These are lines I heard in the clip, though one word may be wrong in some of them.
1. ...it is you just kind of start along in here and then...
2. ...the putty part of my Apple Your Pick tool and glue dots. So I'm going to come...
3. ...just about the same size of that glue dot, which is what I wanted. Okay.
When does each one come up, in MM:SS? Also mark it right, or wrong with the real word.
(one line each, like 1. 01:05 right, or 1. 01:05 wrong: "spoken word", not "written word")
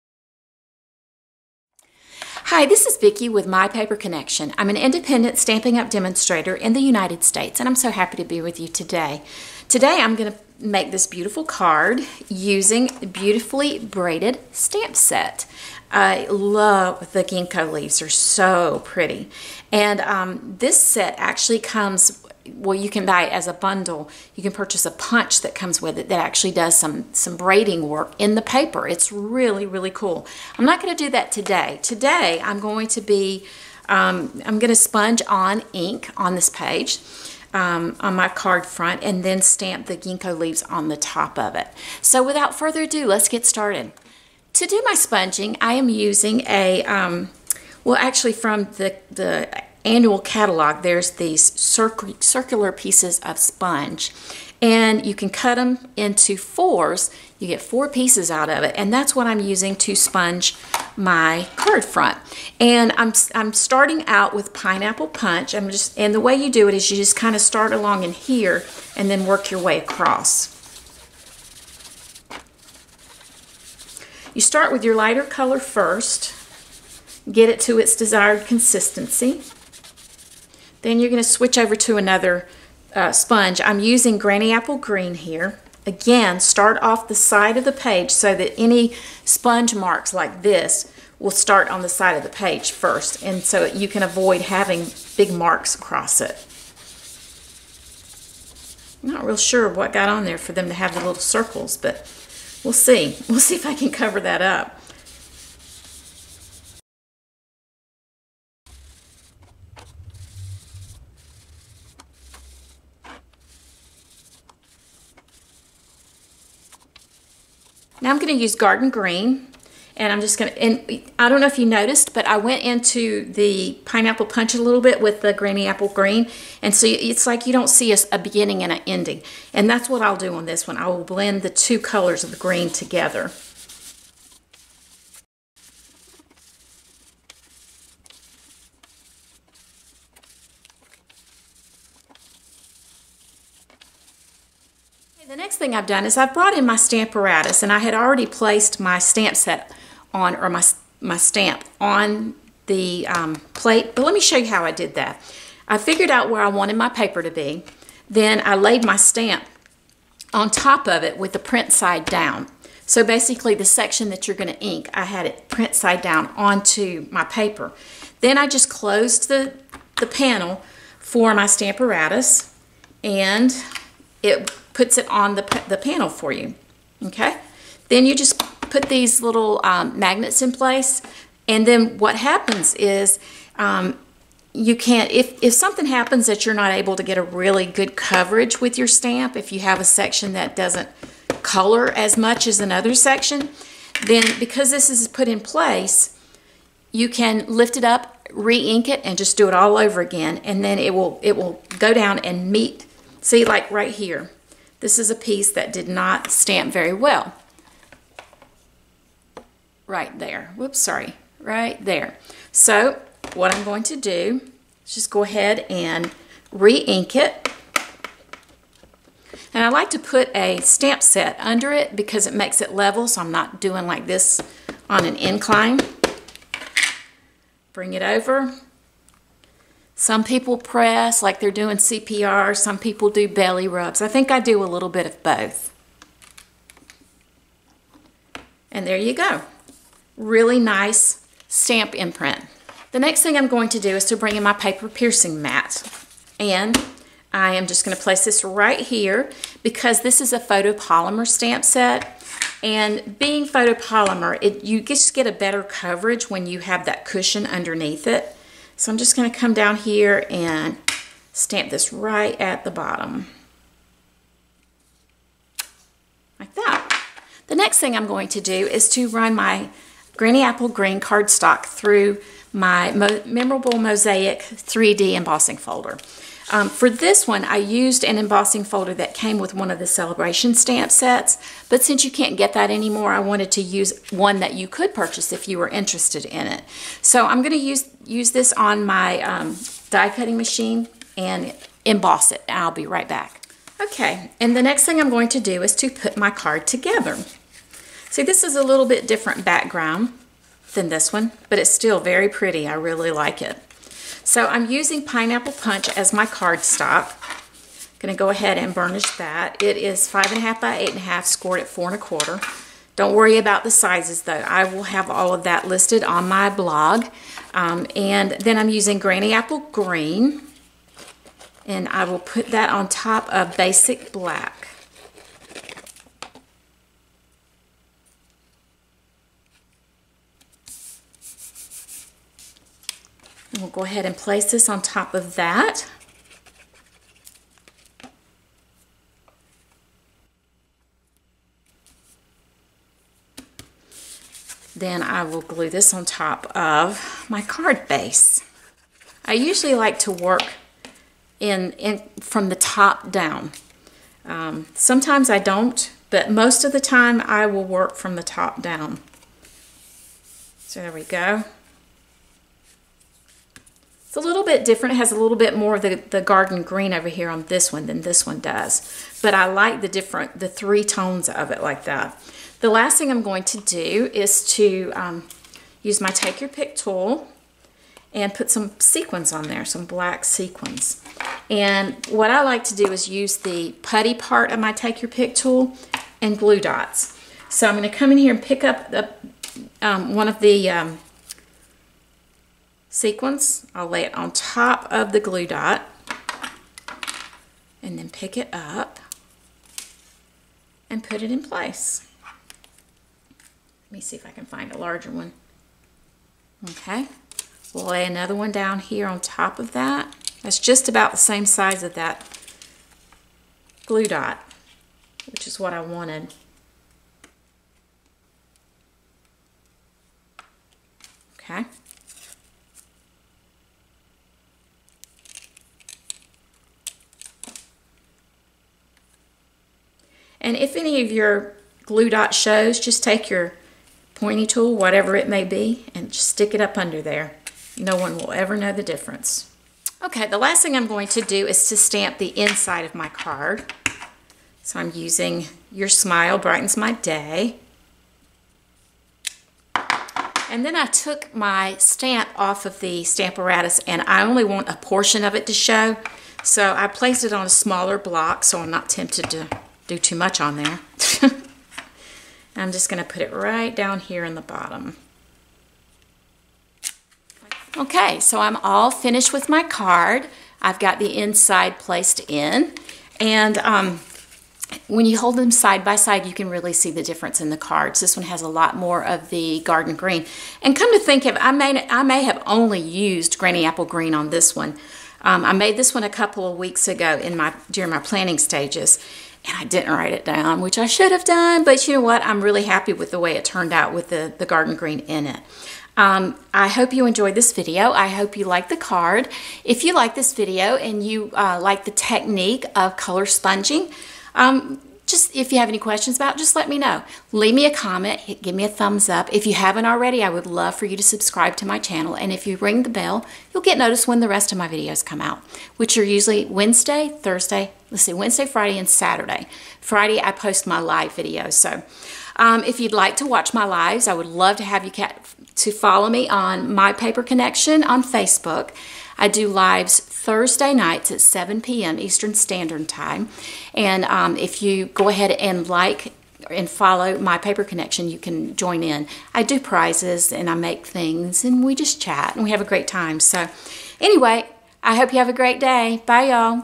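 1. 01:06 right
2. 06:23 wrong: "Take", not "Apple"
3. 06:50 right.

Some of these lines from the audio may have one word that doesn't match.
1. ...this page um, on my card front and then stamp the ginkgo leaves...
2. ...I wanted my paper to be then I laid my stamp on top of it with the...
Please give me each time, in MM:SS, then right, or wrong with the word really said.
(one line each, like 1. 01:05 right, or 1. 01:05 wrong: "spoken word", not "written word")
1. 00:36 right
2. 02:36 right.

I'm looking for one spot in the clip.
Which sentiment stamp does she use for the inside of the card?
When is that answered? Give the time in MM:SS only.
07:25.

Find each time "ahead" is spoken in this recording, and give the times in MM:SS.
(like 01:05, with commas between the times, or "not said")
03:35, 05:08, 05:33, 08:55.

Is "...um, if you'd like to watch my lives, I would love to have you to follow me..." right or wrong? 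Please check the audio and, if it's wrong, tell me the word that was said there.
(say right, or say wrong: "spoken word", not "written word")
right.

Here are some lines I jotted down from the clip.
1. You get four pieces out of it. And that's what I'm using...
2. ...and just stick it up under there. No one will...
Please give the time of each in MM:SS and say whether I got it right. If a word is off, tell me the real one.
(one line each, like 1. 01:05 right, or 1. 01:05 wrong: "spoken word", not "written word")
1. 00:57 right
2. 07:15 right.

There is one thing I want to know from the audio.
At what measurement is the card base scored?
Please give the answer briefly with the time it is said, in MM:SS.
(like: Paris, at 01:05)
4 1/4 inches, at 05:11.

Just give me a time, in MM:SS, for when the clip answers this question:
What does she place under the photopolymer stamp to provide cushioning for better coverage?
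04:04.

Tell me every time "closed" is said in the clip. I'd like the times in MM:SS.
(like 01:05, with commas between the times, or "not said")
02:48.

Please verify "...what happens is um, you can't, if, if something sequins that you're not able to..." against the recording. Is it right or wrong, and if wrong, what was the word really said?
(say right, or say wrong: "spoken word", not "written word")
wrong: "happens", not "sequins".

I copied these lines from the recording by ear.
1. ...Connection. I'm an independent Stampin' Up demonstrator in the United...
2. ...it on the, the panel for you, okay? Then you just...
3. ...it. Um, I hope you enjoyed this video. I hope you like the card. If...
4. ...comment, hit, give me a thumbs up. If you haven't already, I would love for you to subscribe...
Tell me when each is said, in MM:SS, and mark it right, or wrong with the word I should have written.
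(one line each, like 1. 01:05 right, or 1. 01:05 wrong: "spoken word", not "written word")
1. 00:03 right
2. 02:54 right
3. 08:15 right
4. 08:27 right.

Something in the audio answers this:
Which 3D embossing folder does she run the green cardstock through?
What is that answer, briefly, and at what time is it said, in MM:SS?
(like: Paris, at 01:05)
Mosaic, at 04:33.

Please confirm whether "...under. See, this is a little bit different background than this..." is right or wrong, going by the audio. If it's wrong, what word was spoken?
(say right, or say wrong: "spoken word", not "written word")
wrong: "together", not "under".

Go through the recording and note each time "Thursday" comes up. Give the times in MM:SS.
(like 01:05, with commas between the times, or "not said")
08:37, 08:49.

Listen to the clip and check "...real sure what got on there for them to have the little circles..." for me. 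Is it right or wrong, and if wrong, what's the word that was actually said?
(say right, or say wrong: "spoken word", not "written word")
right.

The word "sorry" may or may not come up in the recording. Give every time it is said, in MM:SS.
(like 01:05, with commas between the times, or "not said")
03:30.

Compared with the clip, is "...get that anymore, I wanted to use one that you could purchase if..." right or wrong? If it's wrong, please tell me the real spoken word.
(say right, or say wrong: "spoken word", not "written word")
right.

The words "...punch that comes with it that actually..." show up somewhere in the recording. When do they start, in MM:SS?
00:24.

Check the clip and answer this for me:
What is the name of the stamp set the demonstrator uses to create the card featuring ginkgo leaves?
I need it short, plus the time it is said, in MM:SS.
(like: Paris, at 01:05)
Beautifully Braided, at 00:13.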